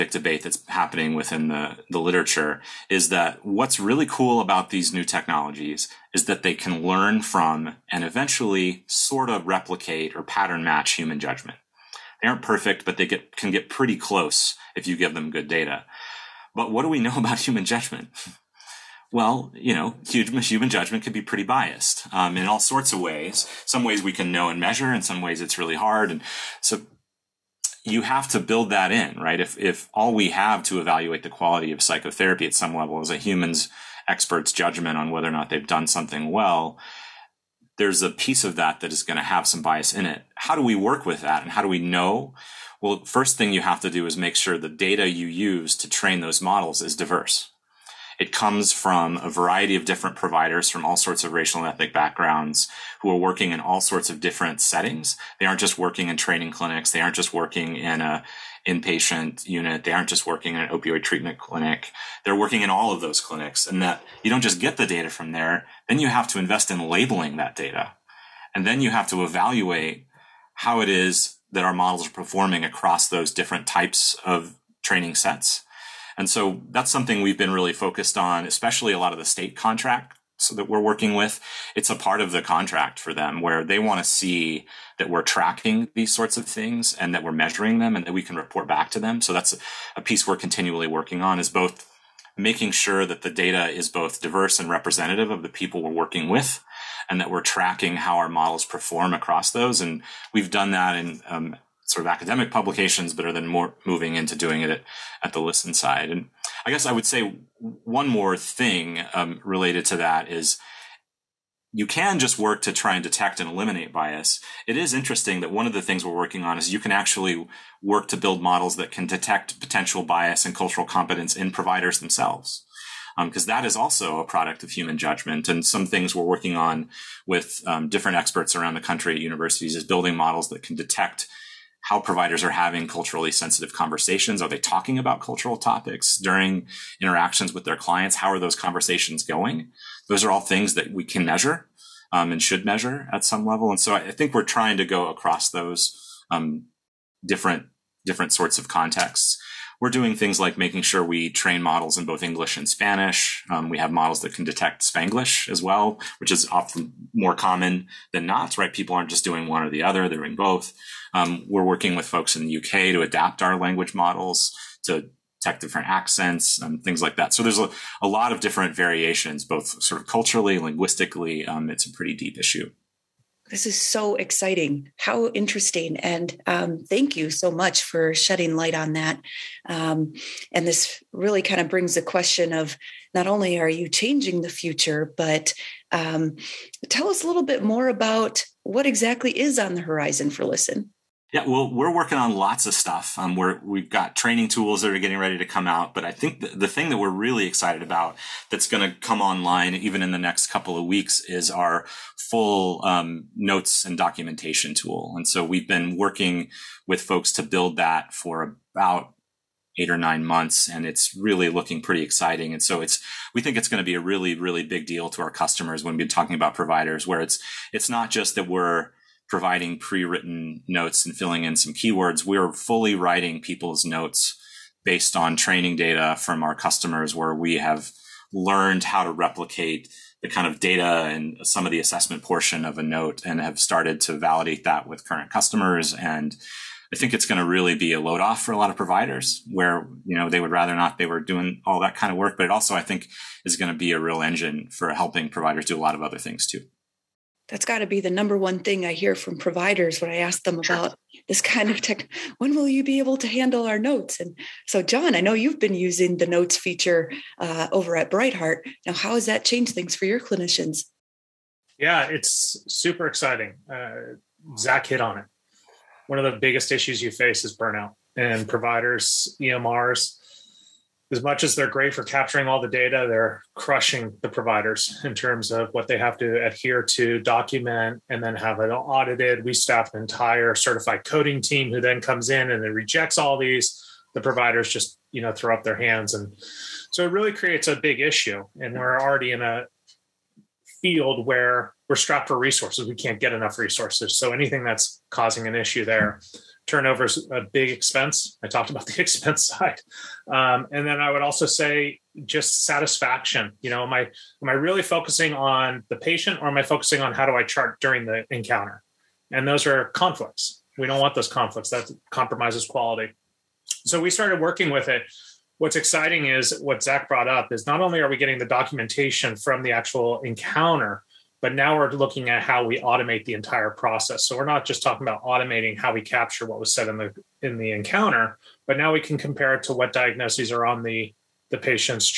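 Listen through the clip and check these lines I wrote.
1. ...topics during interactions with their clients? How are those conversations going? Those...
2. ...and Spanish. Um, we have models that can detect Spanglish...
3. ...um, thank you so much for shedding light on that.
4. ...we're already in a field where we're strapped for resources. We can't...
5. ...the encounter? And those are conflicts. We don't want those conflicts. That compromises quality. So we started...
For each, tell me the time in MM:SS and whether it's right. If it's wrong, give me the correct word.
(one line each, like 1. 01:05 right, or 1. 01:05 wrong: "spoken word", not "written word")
1. 02:15 right
2. 02:32 right
3. 02:56 right
4. 04:48 right
5. 05:08 right.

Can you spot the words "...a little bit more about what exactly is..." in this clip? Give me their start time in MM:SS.
03:07.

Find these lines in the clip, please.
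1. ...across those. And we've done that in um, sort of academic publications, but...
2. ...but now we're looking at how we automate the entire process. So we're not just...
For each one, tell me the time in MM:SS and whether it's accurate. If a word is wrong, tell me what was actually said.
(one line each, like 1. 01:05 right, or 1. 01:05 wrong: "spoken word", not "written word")
1. 01:39 right
2. 05:21 right.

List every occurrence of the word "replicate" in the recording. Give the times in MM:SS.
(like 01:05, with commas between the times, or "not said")
00:09, 03:49.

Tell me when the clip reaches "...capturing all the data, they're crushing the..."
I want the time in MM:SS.
04:32.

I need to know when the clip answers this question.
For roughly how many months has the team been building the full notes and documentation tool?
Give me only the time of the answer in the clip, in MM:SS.
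03:29.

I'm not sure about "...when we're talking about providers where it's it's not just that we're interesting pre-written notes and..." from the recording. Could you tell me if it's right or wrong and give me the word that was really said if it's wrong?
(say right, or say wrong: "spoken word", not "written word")
wrong: "providing", not "interesting".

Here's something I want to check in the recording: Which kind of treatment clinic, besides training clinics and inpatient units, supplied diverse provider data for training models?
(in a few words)
opioid treatment clinic.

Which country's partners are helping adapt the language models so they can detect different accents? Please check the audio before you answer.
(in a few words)
UK.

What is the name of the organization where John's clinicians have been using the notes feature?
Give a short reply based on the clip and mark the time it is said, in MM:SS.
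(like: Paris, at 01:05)
Bright Heart, at 04:18.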